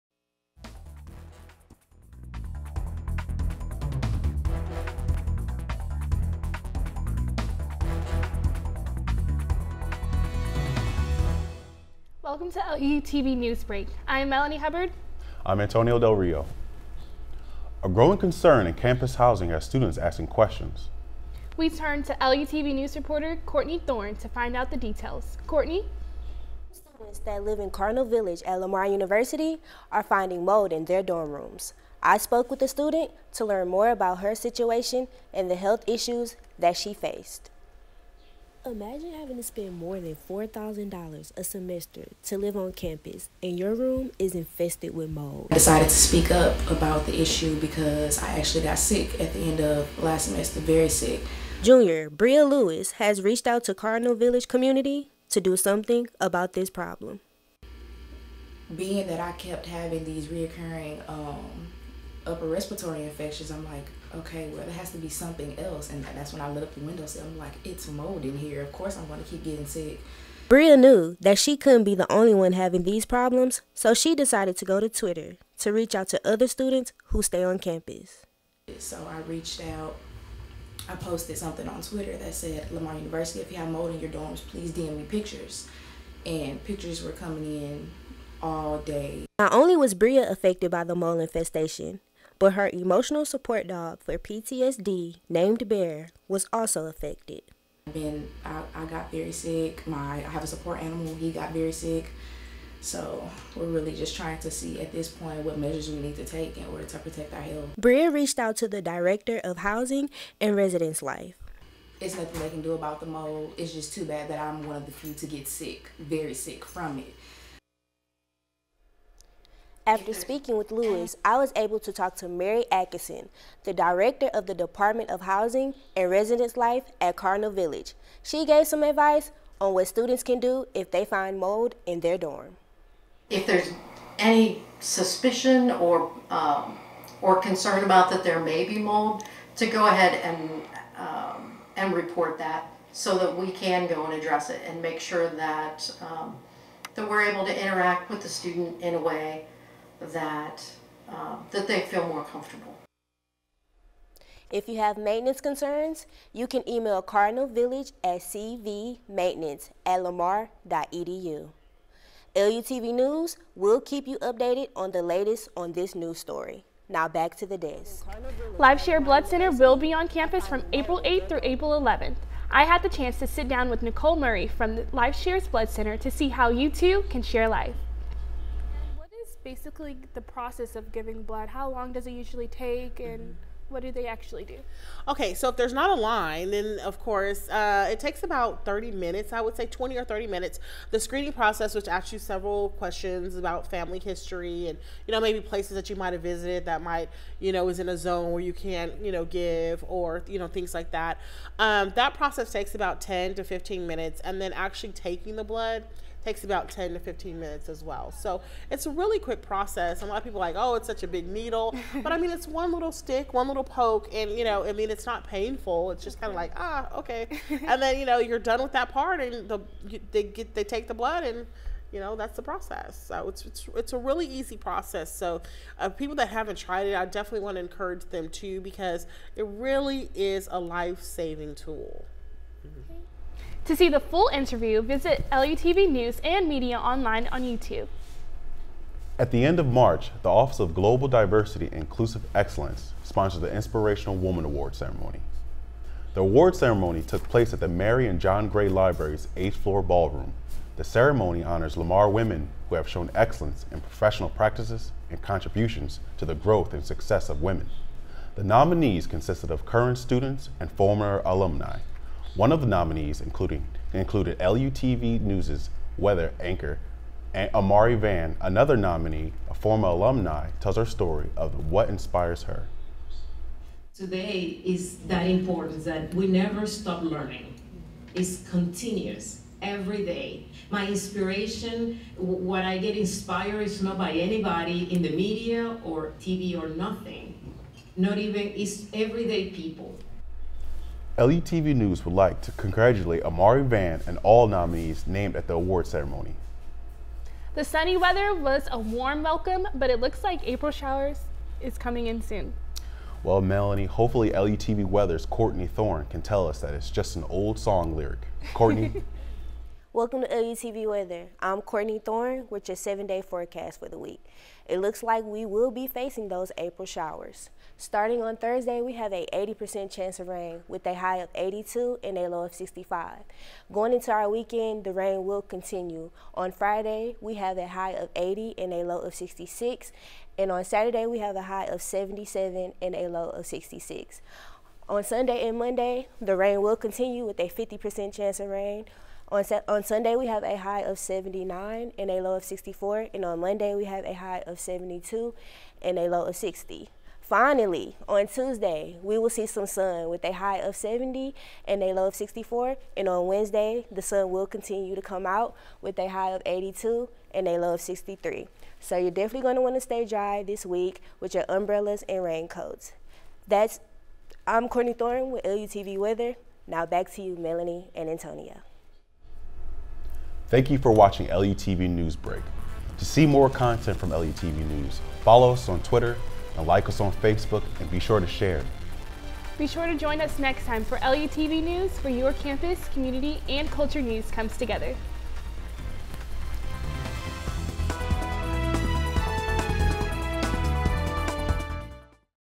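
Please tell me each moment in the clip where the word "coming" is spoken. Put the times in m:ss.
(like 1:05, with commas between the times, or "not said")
1:27, 5:01.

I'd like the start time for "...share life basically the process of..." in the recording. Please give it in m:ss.
2:57.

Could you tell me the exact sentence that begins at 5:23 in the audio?
Going into our weekend, the rain will continue.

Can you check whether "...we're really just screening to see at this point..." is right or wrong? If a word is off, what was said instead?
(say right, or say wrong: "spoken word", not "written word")
wrong: "trying", not "screening".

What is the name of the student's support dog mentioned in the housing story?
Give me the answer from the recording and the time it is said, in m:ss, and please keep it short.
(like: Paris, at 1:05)
Bear, at 1:35.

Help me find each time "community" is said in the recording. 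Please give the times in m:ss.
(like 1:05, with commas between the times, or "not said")
0:54, 6:22.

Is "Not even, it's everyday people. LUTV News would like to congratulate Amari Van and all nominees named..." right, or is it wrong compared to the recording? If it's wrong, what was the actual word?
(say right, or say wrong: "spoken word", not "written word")
right.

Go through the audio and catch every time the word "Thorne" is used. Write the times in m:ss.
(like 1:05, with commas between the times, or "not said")
0:23, 5:05, 5:12, 6:04.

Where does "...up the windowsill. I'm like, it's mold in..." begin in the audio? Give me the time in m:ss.
1:06.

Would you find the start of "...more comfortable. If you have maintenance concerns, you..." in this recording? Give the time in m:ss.
2:32.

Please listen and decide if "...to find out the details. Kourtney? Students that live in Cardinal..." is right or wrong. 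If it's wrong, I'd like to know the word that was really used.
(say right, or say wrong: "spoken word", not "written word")
right.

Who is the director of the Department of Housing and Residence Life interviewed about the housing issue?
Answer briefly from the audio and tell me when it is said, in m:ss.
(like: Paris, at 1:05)
Mary Atkinson, at 2:02.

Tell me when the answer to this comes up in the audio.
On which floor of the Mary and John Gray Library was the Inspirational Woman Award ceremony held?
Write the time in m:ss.
4:09.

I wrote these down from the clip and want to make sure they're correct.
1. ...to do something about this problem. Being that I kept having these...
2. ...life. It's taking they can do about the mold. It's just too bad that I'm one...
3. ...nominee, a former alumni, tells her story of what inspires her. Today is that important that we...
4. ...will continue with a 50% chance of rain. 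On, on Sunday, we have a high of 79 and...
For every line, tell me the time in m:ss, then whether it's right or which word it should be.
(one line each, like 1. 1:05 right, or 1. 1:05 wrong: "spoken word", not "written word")
1. 0:55 right
2. 1:51 wrong: "nothing", not "taking"
3. 4:28 right
4. 5:36 right.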